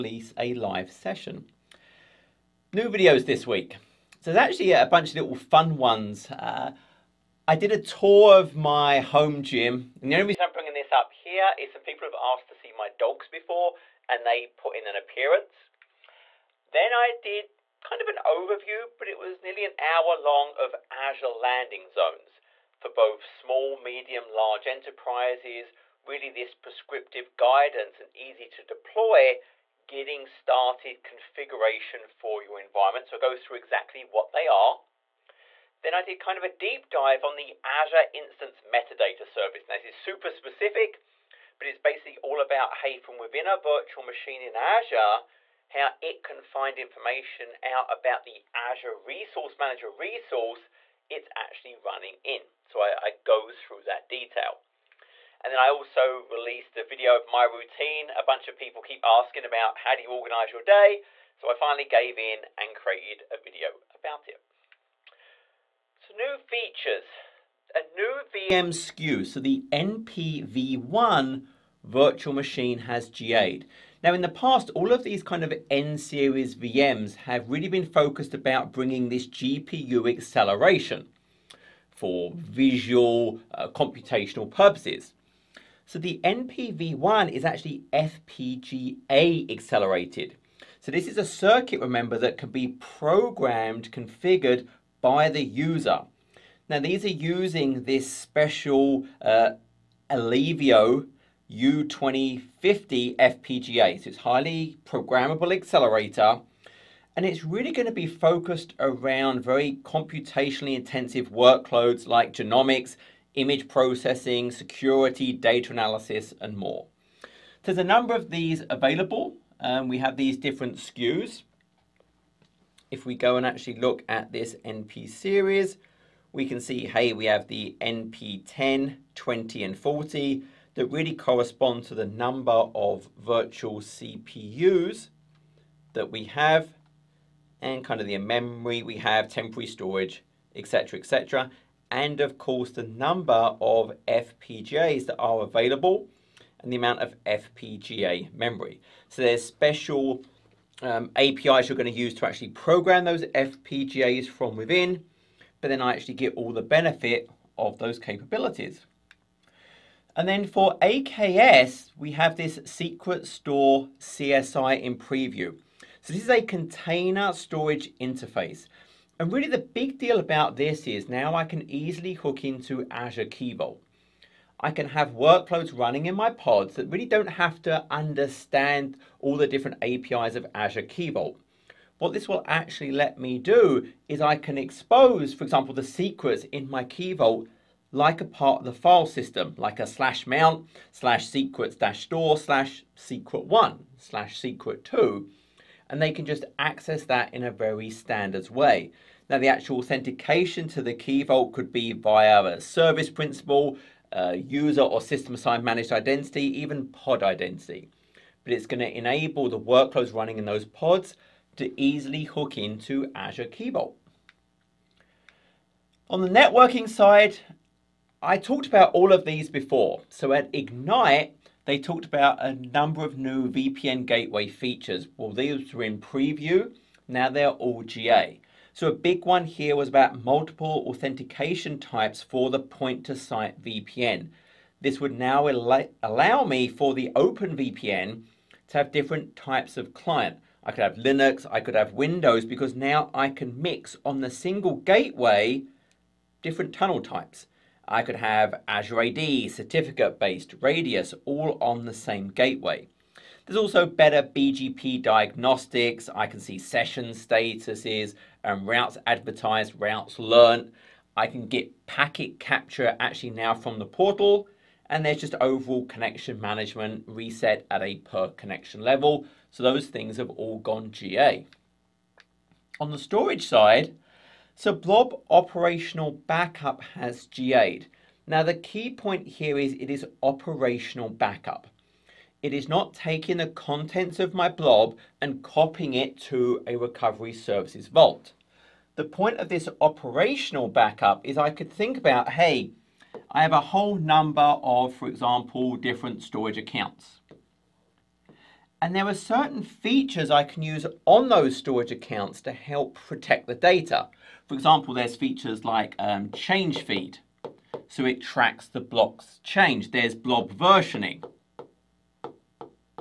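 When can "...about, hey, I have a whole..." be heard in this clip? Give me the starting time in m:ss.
4:51.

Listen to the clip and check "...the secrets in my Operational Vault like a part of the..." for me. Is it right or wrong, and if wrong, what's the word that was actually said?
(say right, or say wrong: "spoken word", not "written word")
wrong: "Key", not "Operational".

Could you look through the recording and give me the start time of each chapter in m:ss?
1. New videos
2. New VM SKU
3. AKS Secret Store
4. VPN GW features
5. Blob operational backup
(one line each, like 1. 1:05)
1. 0:06
2. 1:07
3. 2:39
4. 3:36
5. 4:32.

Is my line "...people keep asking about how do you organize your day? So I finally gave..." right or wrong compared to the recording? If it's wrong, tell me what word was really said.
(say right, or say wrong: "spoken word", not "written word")
right.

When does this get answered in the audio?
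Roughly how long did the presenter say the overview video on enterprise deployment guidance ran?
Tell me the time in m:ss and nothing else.
0:19.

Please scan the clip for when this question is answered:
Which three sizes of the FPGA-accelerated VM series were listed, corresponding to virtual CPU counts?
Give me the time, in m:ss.
2:07.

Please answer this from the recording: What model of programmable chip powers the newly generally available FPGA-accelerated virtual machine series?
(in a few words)
U2050.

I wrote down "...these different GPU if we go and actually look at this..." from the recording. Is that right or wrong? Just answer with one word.
wrong.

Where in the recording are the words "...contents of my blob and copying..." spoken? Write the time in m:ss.
4:43.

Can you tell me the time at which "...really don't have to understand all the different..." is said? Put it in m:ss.
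2:56.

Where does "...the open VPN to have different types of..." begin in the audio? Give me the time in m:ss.
3:56.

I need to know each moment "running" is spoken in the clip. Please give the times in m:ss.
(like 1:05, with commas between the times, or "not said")
0:51, 2:55, 3:30.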